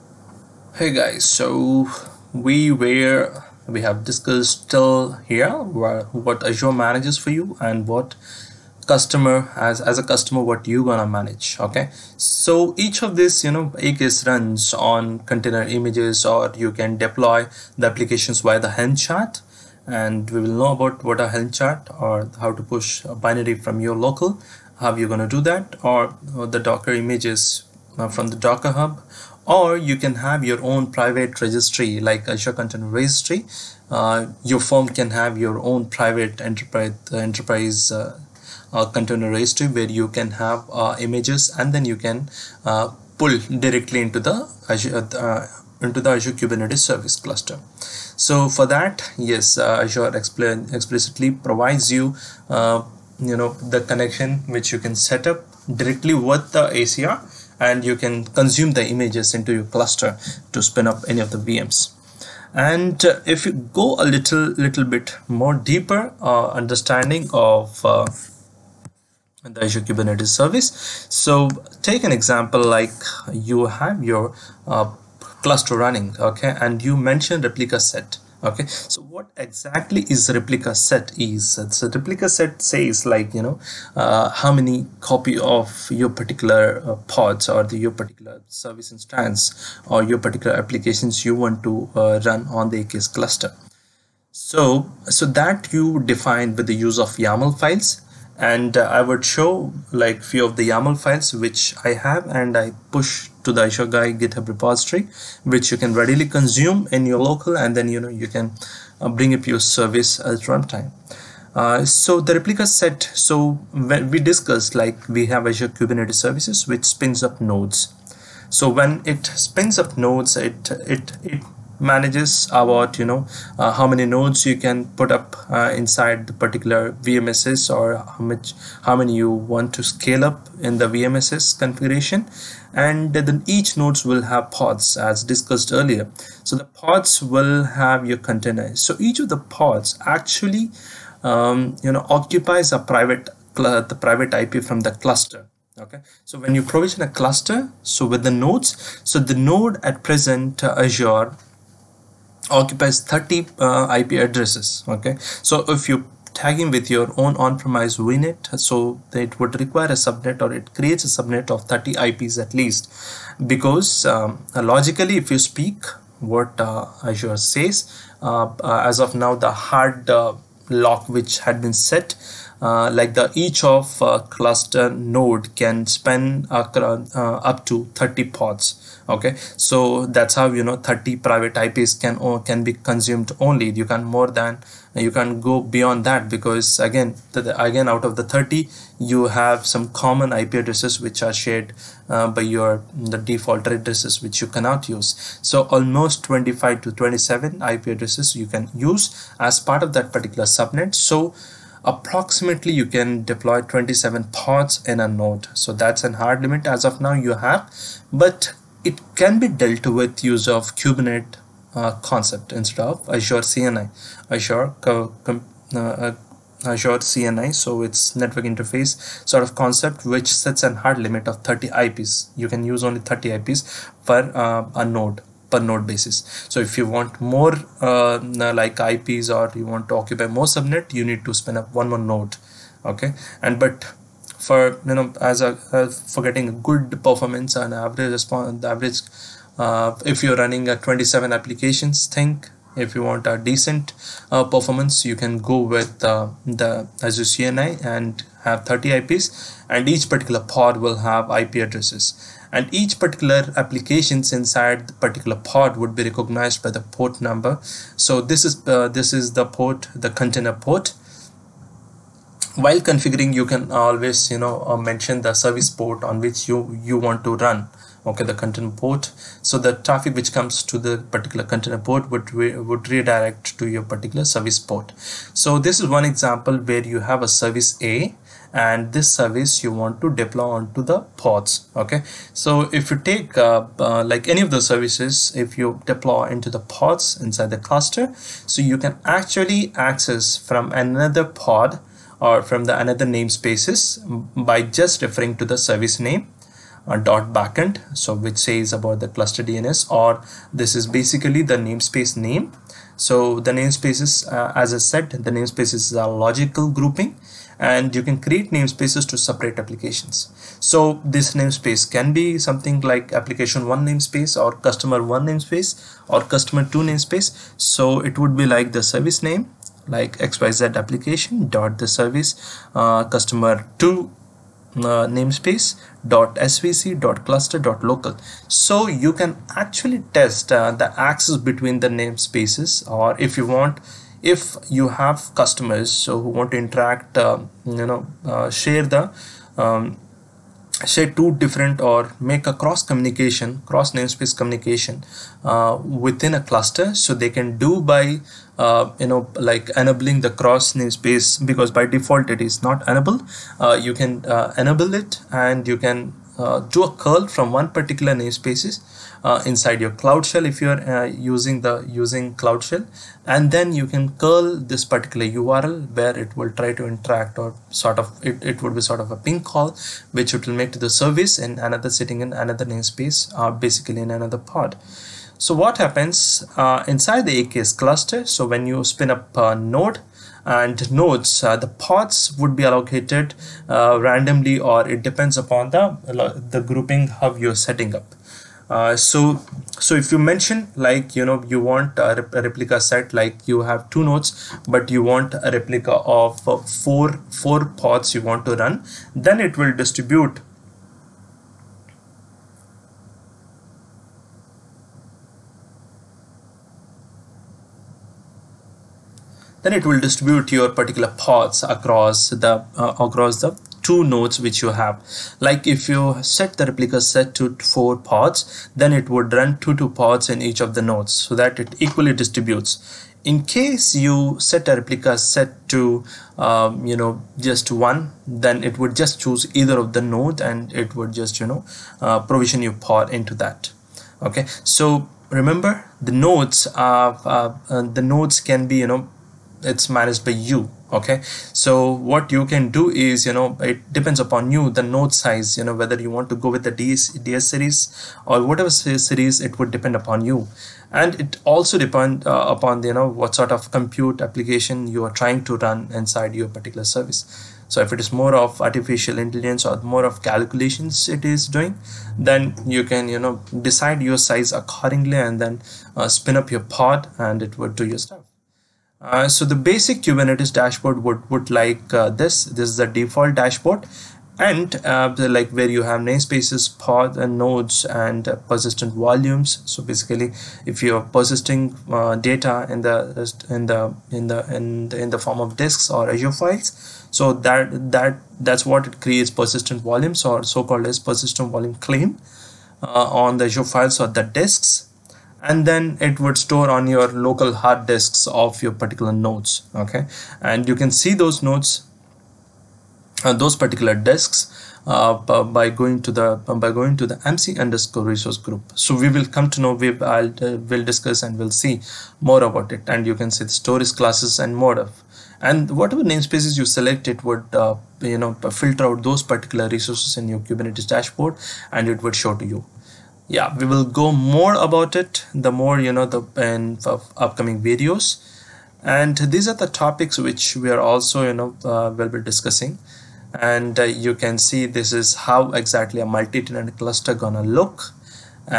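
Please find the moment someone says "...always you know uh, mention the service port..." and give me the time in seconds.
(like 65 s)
263 s.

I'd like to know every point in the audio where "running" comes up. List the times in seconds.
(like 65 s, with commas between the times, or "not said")
75 s, 240 s.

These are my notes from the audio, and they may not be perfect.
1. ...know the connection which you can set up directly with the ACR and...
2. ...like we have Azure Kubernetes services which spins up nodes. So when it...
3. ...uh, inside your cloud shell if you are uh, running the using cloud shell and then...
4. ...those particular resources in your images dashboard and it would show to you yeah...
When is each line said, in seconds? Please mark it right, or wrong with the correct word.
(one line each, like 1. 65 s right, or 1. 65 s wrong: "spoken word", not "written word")
1. 53 s right
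2. 114 s right
3. 359 s wrong: "using", not "running"
4. 519 s wrong: "kubernetes", not "images".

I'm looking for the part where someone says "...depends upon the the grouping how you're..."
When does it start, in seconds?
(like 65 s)
385 s.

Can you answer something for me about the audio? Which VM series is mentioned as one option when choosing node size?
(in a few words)
DS series.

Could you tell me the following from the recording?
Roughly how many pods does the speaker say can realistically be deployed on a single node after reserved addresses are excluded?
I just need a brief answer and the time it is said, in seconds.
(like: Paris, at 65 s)
27, at 203 s.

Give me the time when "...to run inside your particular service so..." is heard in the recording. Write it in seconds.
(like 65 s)
455 s.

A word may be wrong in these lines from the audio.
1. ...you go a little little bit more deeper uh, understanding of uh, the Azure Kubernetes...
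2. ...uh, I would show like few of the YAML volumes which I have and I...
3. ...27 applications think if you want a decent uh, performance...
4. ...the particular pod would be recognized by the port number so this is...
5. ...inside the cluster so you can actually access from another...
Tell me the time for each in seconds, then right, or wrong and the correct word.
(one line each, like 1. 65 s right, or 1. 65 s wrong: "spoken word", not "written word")
1. 63 s right
2. 98 s wrong: "files", not "volumes"
3. 240 s right
4. 254 s right
5. 287 s right.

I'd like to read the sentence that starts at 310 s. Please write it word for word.
So this namespace can be something like application 1 namespace or customer 1 namespace or customer 2 namespace.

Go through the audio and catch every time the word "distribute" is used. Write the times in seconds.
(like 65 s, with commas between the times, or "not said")
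399 s, 409 s, 422 s.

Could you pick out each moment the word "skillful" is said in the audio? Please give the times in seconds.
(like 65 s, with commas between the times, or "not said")
not said.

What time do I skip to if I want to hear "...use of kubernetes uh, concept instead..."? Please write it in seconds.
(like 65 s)
210 s.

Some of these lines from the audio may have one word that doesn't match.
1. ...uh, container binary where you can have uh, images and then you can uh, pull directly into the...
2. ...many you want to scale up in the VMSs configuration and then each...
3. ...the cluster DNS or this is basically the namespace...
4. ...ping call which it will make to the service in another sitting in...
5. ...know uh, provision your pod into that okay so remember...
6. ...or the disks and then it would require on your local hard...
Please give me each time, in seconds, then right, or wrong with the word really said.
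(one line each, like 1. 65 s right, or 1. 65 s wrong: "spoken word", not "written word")
1. 38 s wrong: "registry", not "binary"
2. 128 s right
3. 299 s right
4. 369 s right
5. 431 s right
6. 493 s wrong: "store", not "require".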